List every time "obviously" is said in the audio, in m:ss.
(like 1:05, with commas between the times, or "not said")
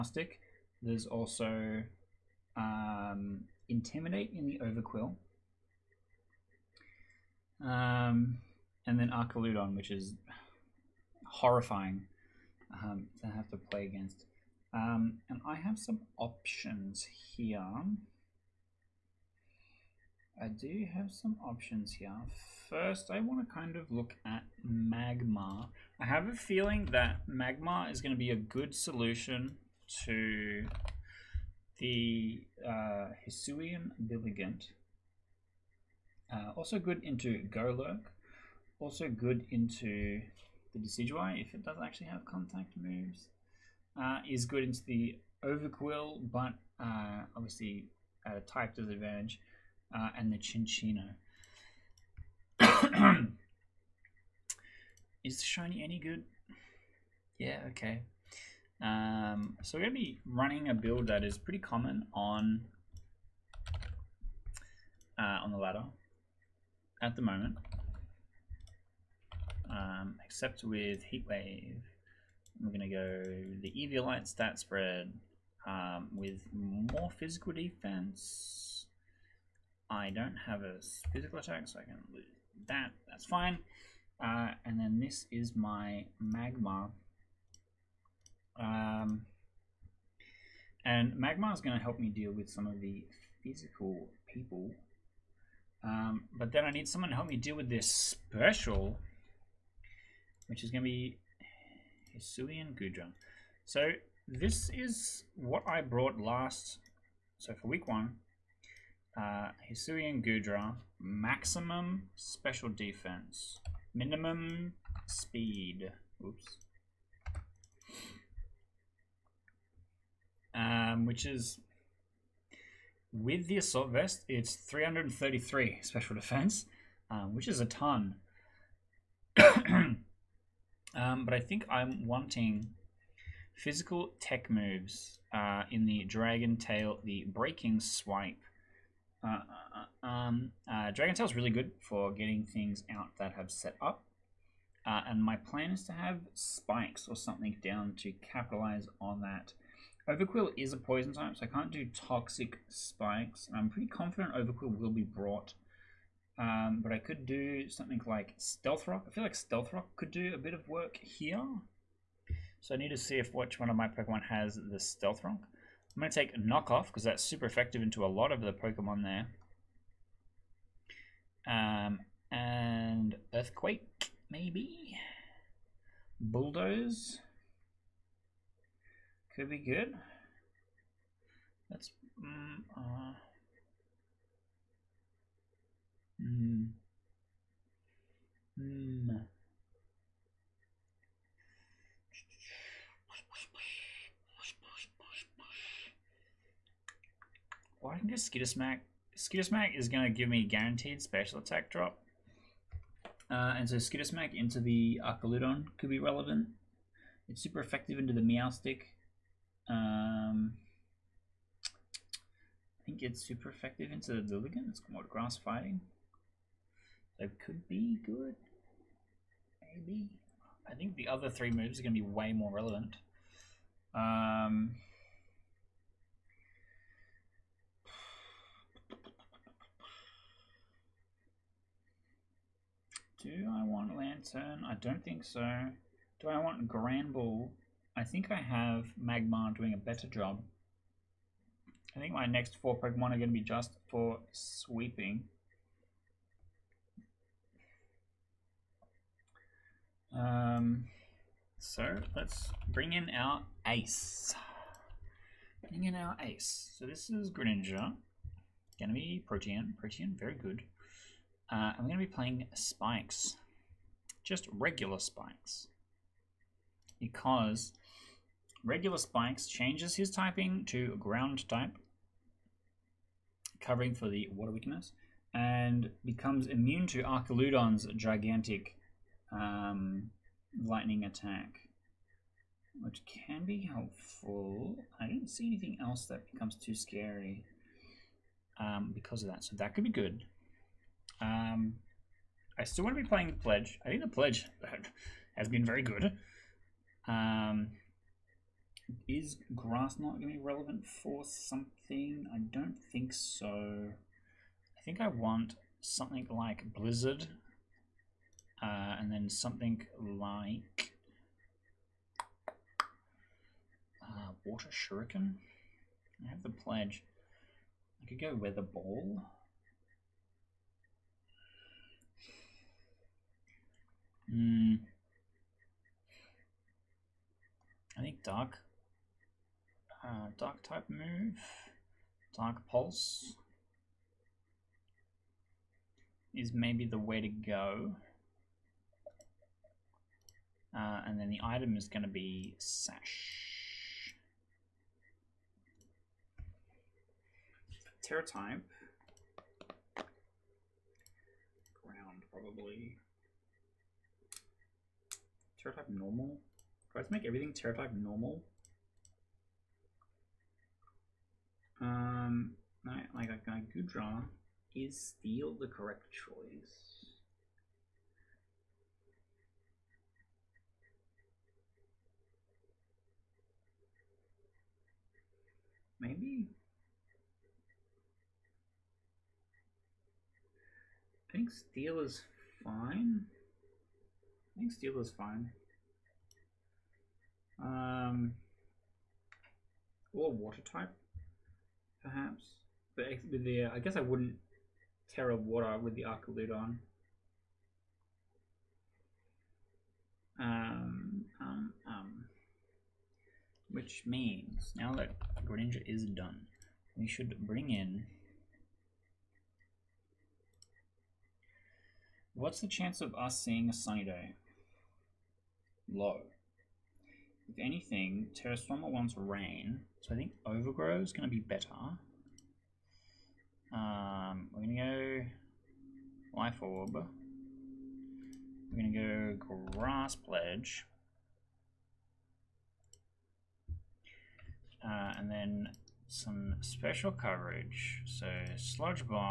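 0:47.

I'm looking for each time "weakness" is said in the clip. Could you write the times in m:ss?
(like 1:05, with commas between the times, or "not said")
4:34.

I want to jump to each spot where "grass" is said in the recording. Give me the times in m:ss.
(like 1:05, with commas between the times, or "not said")
3:35, 4:59, 7:09.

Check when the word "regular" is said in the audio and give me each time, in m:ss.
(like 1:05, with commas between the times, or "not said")
4:24, 4:28.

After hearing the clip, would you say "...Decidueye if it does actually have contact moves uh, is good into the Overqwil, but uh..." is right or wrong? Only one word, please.
right.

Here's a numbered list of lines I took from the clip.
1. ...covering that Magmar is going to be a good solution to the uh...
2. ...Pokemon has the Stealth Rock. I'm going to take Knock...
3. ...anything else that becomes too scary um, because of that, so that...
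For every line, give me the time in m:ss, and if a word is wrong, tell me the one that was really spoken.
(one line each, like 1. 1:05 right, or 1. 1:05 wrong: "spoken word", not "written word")
1. 0:26 wrong: "feeling", not "covering"
2. 2:43 right
3. 4:45 right.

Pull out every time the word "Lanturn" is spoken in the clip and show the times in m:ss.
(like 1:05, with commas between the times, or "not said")
3:53.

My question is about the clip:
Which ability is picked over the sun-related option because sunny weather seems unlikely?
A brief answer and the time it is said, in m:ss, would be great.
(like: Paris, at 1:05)
Overgrow, at 7:00.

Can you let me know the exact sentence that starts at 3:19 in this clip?
Skitter Smack is going to give me guaranteed special attack drop.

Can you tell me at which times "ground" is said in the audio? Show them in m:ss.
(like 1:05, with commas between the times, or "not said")
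4:30, 5:51.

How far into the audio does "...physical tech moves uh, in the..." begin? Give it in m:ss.
2:13.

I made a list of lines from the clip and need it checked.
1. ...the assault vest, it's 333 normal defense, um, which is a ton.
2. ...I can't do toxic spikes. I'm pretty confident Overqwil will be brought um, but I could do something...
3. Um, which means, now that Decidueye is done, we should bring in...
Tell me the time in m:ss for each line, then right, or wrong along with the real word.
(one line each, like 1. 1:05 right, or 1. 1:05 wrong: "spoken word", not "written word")
1. 2:03 wrong: "special", not "normal"
2. 2:31 right
3. 6:40 wrong: "Greninja", not "Decidueye".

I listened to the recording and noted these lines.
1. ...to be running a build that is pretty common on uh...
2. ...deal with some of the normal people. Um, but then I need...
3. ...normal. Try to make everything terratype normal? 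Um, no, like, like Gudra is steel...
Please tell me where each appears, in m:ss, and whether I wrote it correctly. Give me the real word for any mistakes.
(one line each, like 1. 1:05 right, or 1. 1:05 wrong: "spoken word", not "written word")
1. 0:59 right
2. 1:32 wrong: "physical", not "normal"
3. 5:55 right.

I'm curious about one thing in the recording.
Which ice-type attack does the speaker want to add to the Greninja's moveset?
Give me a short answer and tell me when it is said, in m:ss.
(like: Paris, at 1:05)
Blizzard, at 5:06.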